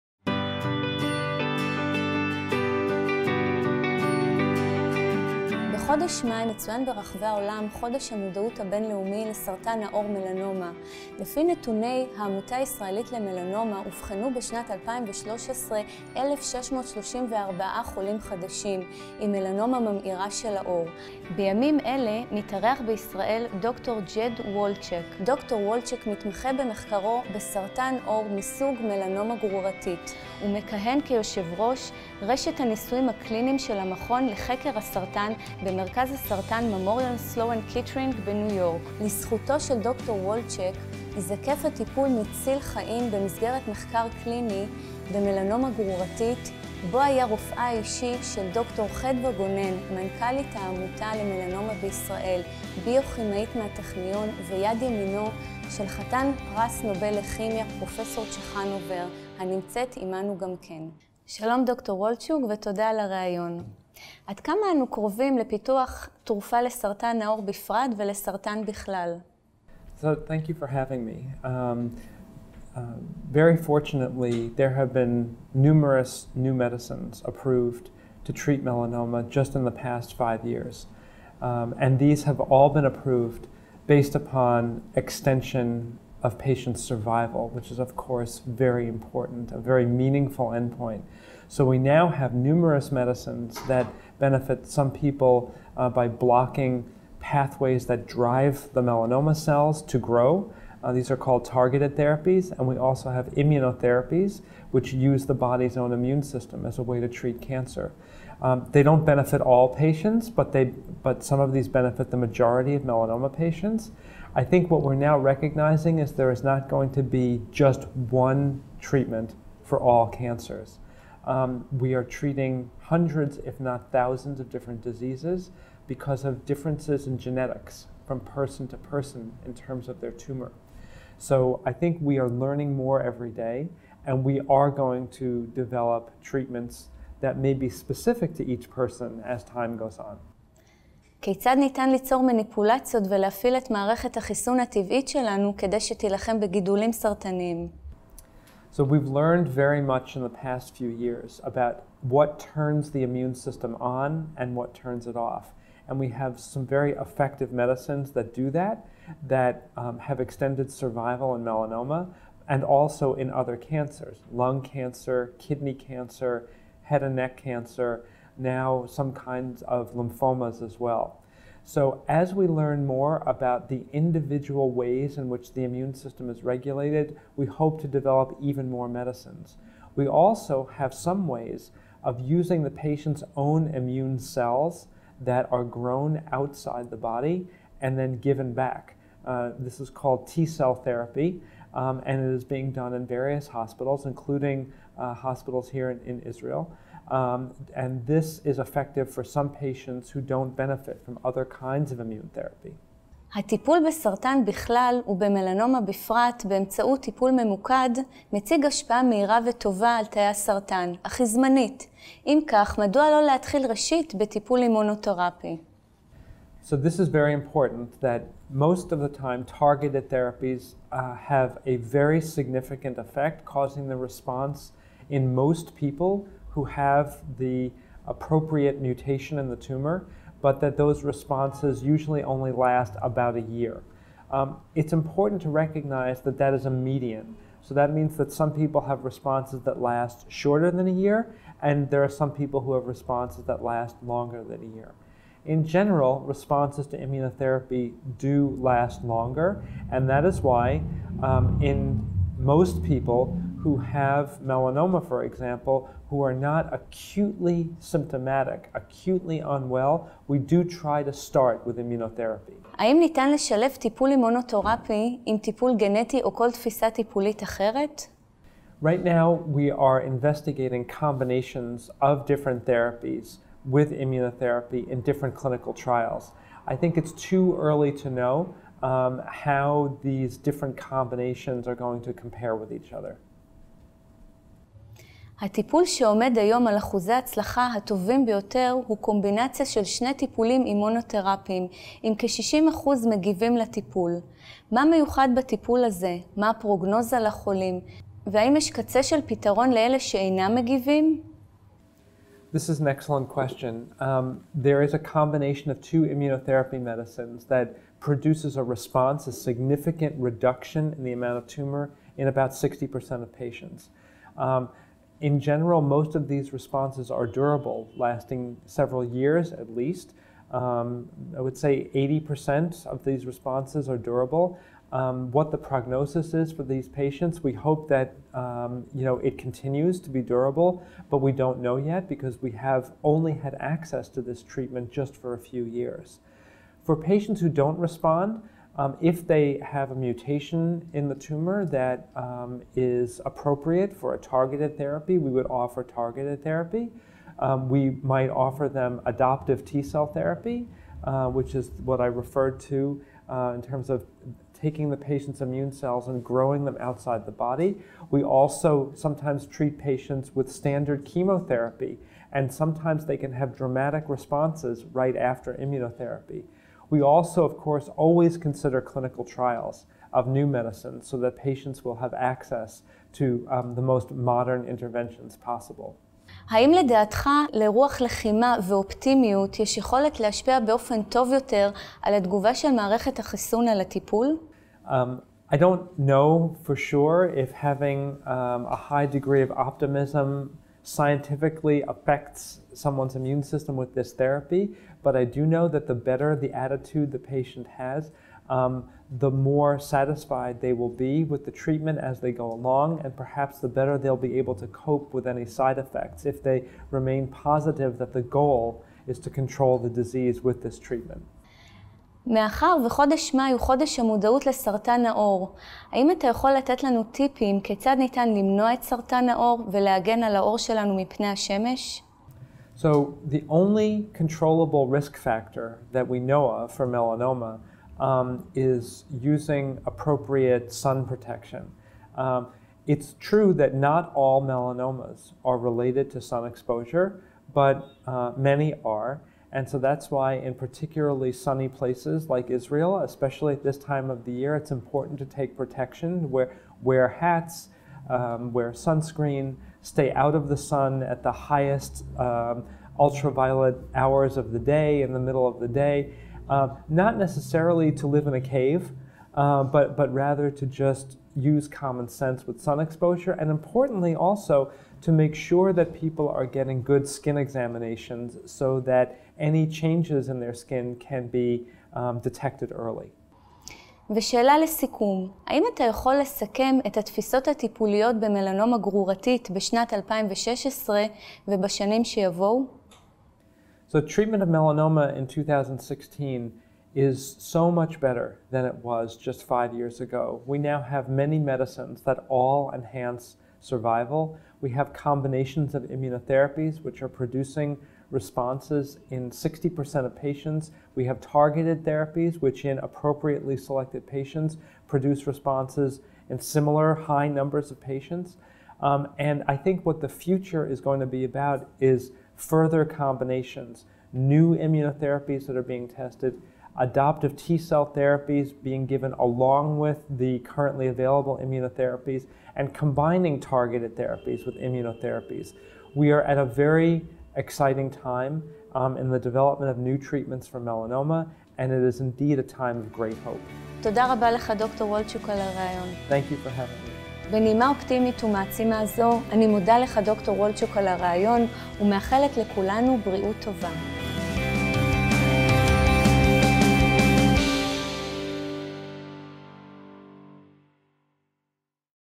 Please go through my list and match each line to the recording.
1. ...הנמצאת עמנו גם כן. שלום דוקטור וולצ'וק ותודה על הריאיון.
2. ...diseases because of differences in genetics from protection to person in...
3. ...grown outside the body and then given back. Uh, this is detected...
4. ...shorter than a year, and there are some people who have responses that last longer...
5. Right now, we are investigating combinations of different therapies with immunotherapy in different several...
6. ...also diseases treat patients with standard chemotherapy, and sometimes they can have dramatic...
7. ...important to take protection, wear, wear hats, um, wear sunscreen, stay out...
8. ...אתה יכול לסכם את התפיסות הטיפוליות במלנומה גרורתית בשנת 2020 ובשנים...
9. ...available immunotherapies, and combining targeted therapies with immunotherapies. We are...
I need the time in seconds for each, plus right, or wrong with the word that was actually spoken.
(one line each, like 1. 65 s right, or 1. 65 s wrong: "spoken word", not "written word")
1. 59 s right
2. 124 s wrong: "person", not "protection"
3. 185 s wrong: "called", not "detected"
4. 240 s right
5. 268 s wrong: "clinical", not "several"
6. 358 s wrong: "sometimes", not "diseases"
7. 444 s right
8. 475 s wrong: "2016", not "2020"
9. 520 s right.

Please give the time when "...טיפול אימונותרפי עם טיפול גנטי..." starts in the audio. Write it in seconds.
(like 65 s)
263 s.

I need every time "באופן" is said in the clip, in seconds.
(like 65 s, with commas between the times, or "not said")
380 s.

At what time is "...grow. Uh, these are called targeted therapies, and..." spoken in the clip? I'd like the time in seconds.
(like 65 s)
99 s.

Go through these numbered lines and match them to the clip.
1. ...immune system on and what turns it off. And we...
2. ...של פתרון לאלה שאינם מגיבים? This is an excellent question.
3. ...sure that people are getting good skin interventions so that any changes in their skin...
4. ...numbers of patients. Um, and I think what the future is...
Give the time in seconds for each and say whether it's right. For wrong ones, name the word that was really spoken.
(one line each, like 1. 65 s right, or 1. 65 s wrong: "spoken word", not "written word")
1. 153 s right
2. 299 s right
3. 465 s wrong: "examinations", not "interventions"
4. 507 s right.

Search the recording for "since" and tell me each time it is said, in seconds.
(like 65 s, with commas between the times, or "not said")
not said.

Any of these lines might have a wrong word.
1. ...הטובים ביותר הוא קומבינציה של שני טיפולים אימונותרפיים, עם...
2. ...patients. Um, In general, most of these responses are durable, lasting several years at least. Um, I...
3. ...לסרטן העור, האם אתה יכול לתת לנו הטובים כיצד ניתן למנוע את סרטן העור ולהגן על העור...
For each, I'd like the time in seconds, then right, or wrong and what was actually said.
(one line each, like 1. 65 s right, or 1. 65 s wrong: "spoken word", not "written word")
1. 287 s right
2. 313 s right
3. 414 s wrong: "טיפים", not "הטובים".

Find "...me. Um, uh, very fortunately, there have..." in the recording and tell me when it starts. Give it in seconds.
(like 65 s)
71 s.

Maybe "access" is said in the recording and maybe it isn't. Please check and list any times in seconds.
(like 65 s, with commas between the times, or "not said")
333 s, 372 s.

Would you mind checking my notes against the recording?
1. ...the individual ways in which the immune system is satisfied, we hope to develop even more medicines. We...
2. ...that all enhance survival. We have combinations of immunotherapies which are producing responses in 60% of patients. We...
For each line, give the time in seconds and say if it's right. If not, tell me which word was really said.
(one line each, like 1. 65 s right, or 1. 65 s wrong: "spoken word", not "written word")
1. 173 s wrong: "regulated", not "satisfied"
2. 492 s right.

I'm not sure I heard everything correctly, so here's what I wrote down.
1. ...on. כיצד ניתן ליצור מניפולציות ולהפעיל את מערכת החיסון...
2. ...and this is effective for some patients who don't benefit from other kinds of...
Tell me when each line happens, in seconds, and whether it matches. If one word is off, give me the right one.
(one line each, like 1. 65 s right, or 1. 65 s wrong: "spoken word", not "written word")
1. 139 s right
2. 197 s right.